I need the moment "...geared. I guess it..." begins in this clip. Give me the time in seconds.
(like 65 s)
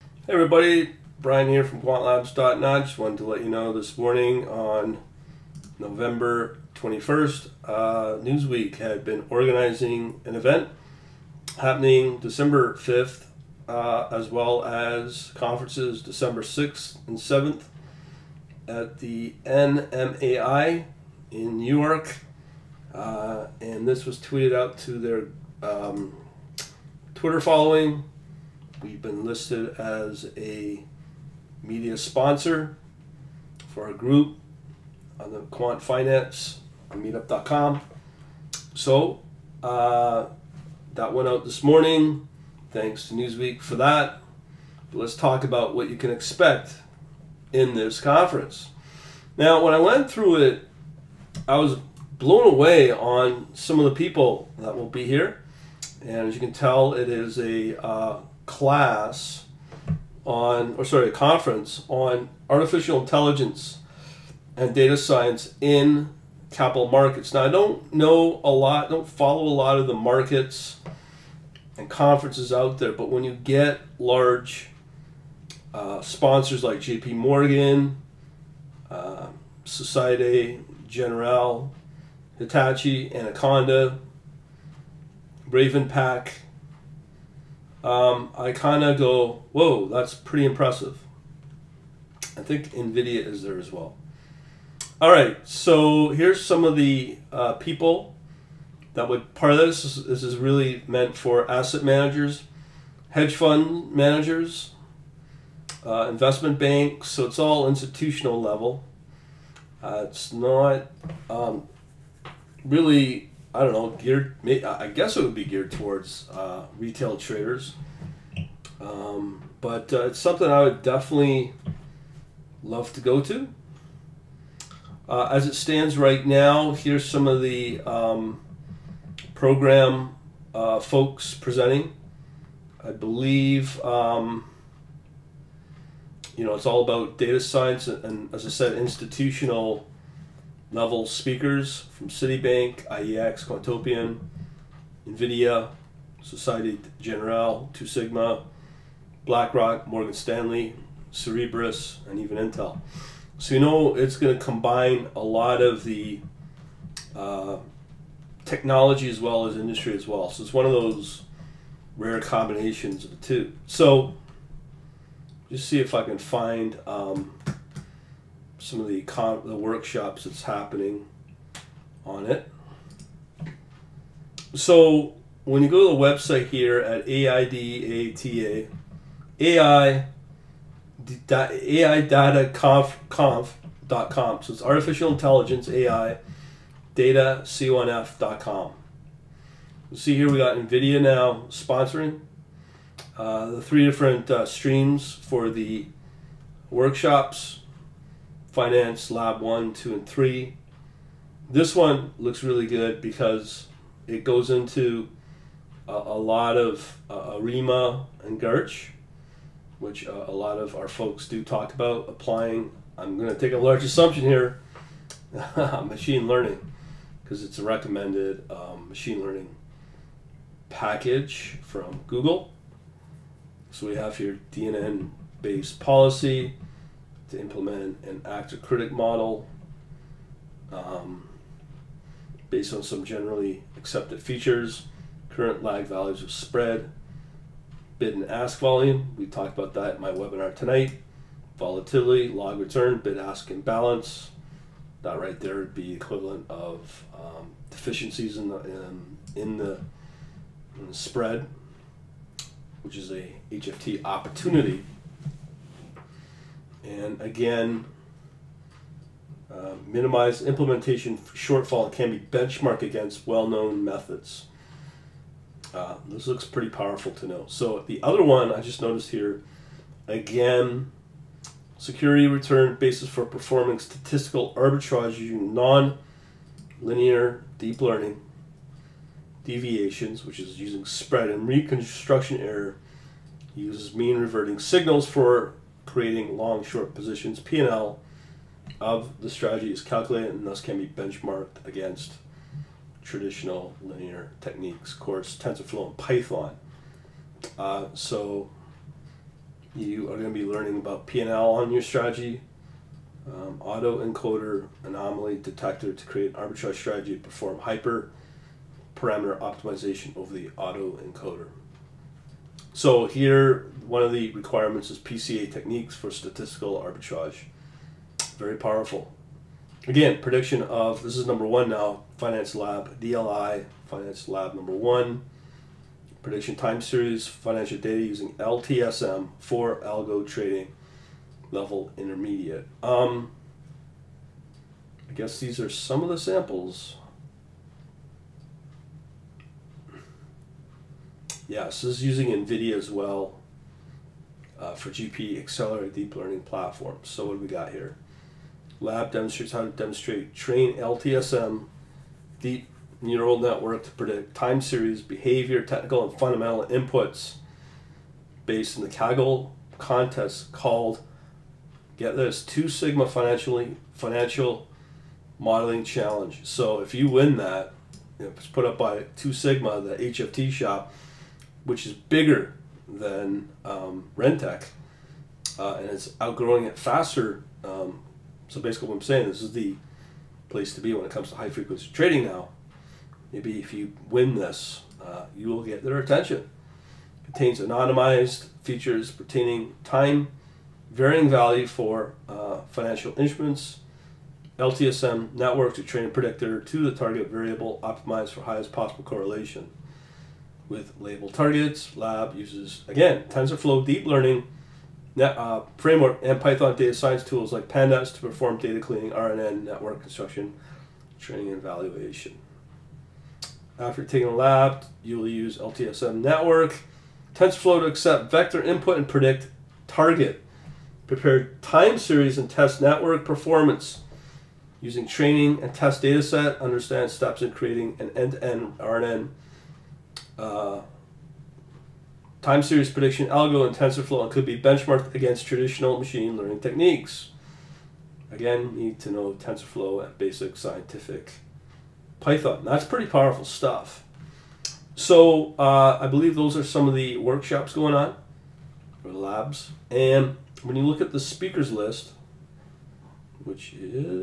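113 s.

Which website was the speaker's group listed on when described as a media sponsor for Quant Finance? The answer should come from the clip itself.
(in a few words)
meetup.com.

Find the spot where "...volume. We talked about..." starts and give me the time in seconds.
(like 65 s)
238 s.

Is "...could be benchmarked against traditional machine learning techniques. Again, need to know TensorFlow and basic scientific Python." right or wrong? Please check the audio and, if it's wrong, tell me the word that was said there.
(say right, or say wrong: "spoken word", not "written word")
right.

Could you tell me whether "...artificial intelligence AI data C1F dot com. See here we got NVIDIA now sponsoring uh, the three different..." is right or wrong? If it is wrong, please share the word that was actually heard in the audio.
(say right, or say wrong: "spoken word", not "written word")
right.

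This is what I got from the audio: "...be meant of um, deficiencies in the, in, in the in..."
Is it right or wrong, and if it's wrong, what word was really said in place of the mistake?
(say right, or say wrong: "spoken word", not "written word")
wrong: "equivalent", not "meant".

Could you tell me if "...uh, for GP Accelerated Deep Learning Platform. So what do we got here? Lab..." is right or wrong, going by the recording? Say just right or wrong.
right.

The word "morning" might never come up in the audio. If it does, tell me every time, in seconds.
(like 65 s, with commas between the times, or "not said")
3 s, 41 s.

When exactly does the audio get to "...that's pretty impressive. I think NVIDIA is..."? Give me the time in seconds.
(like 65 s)
89 s.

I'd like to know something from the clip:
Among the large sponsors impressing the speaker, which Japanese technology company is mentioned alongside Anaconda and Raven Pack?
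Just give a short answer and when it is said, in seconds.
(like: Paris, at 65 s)
Hitachi, at 82 s.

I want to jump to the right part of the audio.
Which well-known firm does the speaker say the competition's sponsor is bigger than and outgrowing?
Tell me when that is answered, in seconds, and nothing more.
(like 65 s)
374 s.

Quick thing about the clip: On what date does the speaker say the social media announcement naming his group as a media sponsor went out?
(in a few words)
November 21st.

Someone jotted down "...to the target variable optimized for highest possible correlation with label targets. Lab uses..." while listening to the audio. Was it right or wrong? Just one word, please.
right.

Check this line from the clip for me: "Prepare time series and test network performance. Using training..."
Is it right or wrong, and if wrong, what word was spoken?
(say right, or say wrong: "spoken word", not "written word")
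right.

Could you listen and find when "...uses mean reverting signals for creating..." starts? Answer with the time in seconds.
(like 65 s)
283 s.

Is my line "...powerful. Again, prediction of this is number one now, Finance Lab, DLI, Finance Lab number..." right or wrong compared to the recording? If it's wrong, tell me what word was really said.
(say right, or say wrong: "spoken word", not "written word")
right.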